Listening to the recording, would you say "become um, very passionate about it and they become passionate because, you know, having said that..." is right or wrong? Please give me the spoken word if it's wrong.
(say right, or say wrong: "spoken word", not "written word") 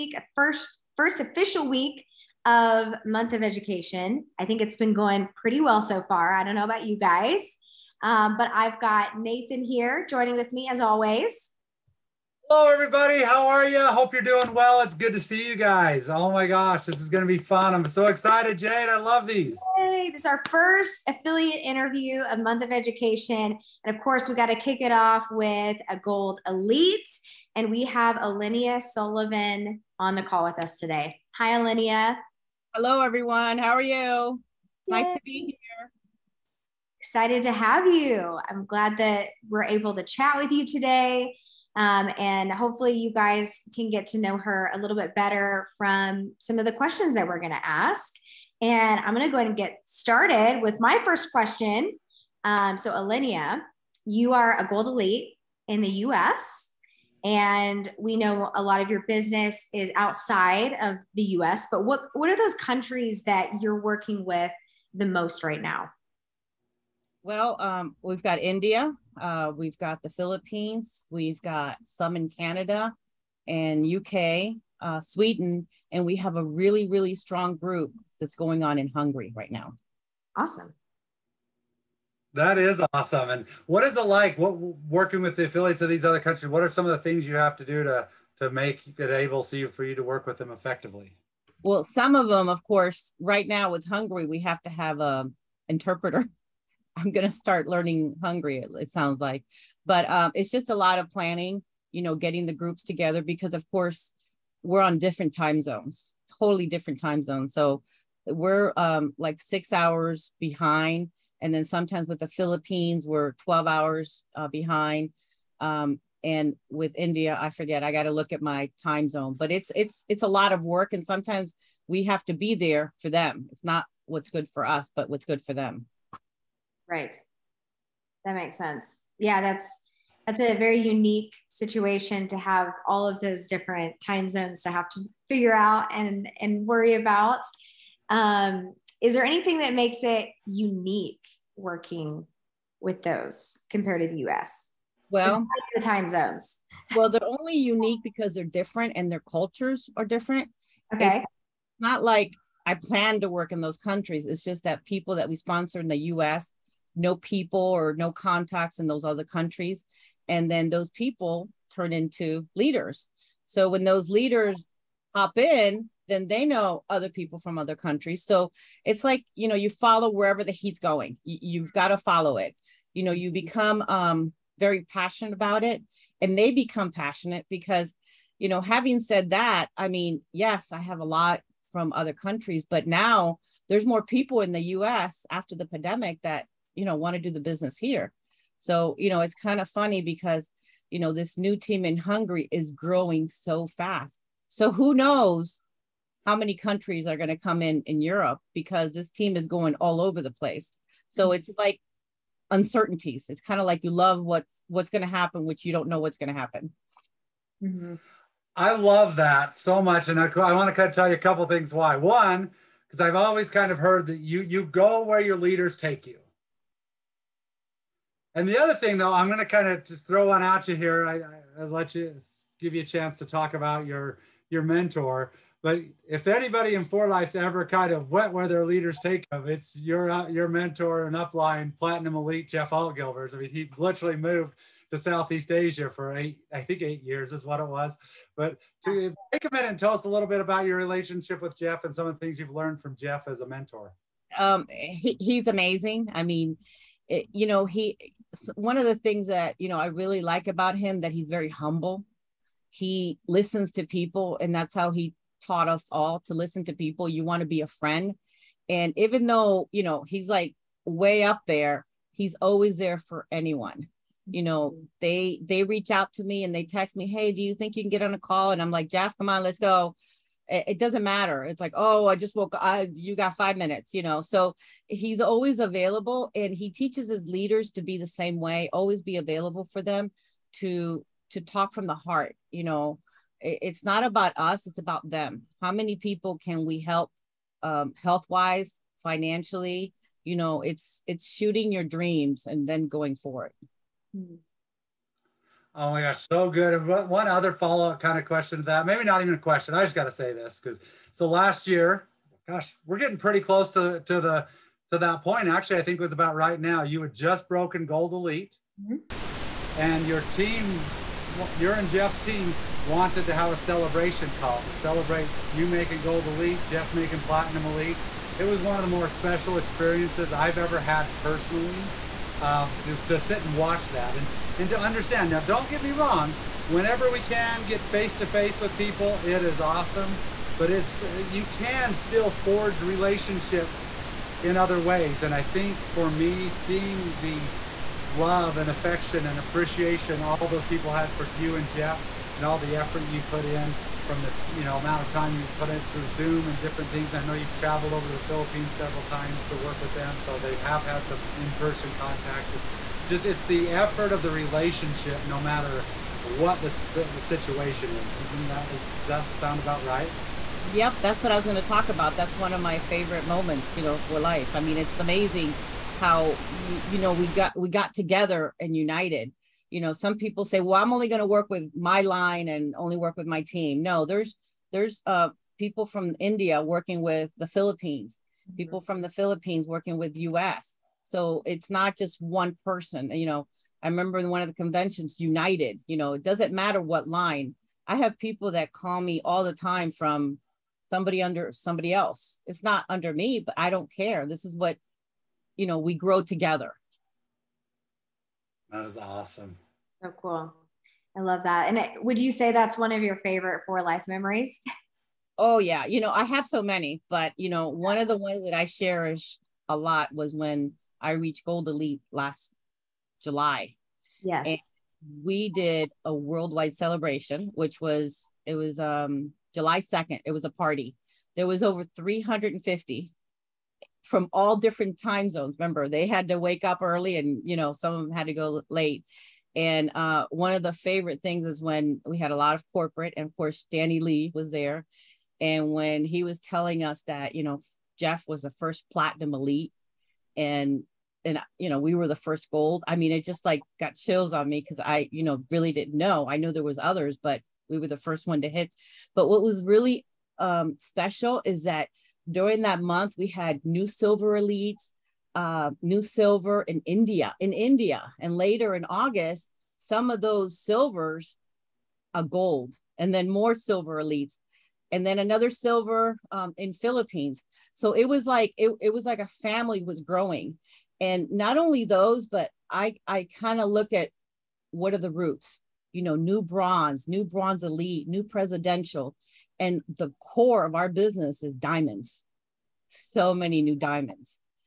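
right.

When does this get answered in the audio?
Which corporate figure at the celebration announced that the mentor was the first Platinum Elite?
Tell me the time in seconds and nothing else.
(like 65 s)
433 s.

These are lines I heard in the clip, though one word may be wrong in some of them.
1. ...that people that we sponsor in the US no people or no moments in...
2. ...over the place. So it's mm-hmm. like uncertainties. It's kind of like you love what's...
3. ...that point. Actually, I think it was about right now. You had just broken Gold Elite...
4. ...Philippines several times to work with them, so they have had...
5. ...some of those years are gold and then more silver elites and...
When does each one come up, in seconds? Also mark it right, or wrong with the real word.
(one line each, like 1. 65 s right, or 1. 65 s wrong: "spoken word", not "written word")
1. 154 s wrong: "contacts", not "moments"
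2. 199 s right
3. 304 s right
4. 348 s right
5. 459 s wrong: "silvers", not "years".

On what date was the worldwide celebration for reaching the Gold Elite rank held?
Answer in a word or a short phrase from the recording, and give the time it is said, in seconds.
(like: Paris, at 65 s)
July 2, at 419 s.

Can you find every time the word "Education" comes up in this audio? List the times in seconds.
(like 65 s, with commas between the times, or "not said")
3 s, 22 s.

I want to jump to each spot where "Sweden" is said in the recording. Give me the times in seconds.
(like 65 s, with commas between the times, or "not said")
74 s.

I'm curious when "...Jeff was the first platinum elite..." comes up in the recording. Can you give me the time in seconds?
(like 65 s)
437 s.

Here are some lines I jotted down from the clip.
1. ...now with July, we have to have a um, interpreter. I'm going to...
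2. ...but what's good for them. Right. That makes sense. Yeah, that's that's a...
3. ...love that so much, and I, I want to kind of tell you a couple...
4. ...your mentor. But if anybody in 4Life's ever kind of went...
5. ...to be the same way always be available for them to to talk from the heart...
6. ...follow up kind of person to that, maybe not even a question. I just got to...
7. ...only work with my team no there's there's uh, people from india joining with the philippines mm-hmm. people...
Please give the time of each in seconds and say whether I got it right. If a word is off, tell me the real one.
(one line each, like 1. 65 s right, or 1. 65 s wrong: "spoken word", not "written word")
1. 93 s wrong: "Hungary", not "July"
2. 124 s right
3. 208 s right
4. 224 s right
5. 277 s right
6. 297 s wrong: "question", not "person"
7. 372 s wrong: "working", not "joining".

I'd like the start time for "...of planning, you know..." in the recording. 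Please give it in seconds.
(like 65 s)
100 s.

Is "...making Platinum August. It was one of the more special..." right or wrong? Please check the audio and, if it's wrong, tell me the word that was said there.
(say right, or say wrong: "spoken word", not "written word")
wrong: "Elite", not "August".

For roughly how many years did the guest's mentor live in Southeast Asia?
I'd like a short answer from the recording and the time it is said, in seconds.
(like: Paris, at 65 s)
8 years, at 236 s.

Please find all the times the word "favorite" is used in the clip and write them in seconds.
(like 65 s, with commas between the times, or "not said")
362 s, 403 s, 430 s.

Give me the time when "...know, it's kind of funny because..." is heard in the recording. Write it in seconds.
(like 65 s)
189 s.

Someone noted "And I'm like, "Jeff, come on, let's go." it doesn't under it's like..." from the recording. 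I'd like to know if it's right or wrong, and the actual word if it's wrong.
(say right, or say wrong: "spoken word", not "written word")
wrong: "matter", not "under".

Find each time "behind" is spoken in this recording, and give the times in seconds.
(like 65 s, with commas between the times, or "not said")
110 s, 114 s.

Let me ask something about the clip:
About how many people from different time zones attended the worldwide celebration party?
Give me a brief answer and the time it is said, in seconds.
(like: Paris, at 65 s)
Over 350, at 421 s.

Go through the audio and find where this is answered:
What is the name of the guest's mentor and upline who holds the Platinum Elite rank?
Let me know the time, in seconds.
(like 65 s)
232 s.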